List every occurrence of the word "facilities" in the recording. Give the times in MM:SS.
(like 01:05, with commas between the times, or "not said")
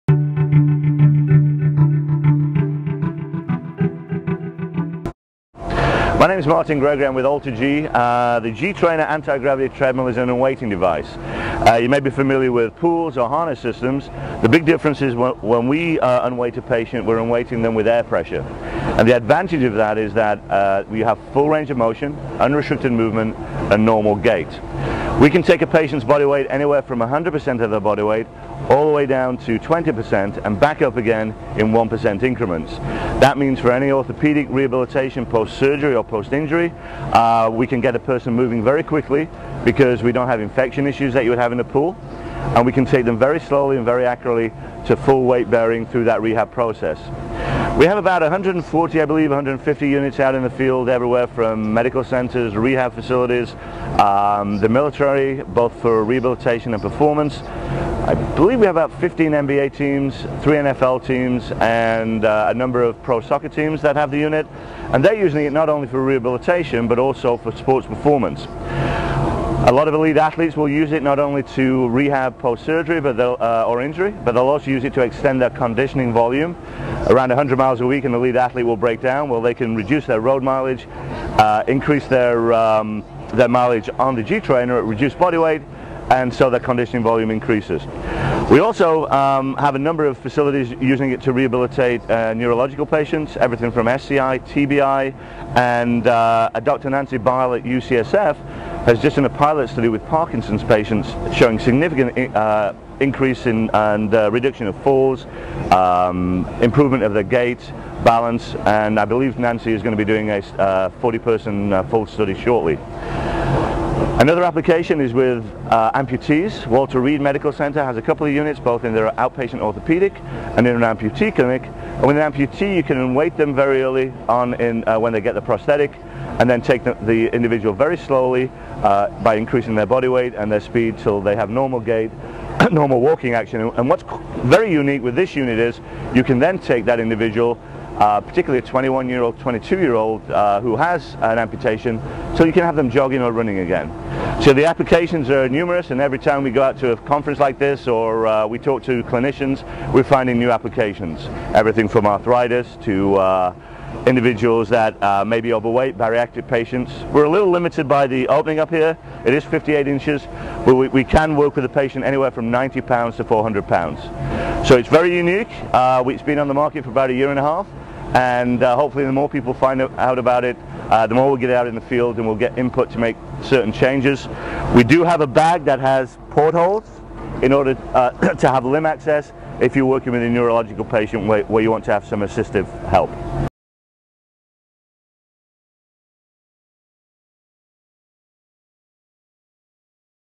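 00:52, 01:30.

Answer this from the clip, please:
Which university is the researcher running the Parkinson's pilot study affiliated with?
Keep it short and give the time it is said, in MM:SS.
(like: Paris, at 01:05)
UCSF, at 01:37.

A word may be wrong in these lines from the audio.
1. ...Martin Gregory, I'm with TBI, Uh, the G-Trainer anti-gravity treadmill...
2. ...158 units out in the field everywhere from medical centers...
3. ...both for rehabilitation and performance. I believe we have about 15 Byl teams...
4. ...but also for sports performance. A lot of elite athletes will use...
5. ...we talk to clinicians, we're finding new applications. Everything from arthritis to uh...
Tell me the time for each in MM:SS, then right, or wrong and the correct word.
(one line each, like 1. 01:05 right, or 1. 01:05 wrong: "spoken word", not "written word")
1. 00:06 wrong: "AlterG", not "TBI"
2. 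00:49 wrong: "150", not "158"
3. 00:55 wrong: "NBA", not "Byl"
4. 01:06 right
5. 02:28 right.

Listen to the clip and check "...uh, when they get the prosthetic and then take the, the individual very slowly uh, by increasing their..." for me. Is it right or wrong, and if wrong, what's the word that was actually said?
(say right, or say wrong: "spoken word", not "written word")
right.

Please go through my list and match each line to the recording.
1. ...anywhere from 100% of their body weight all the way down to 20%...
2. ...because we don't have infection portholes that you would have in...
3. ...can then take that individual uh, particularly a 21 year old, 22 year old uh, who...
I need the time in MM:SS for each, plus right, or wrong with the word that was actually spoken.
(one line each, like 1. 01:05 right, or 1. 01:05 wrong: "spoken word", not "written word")
1. 00:26 right
2. 00:39 wrong: "issues", not "portholes"
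3. 02:16 right.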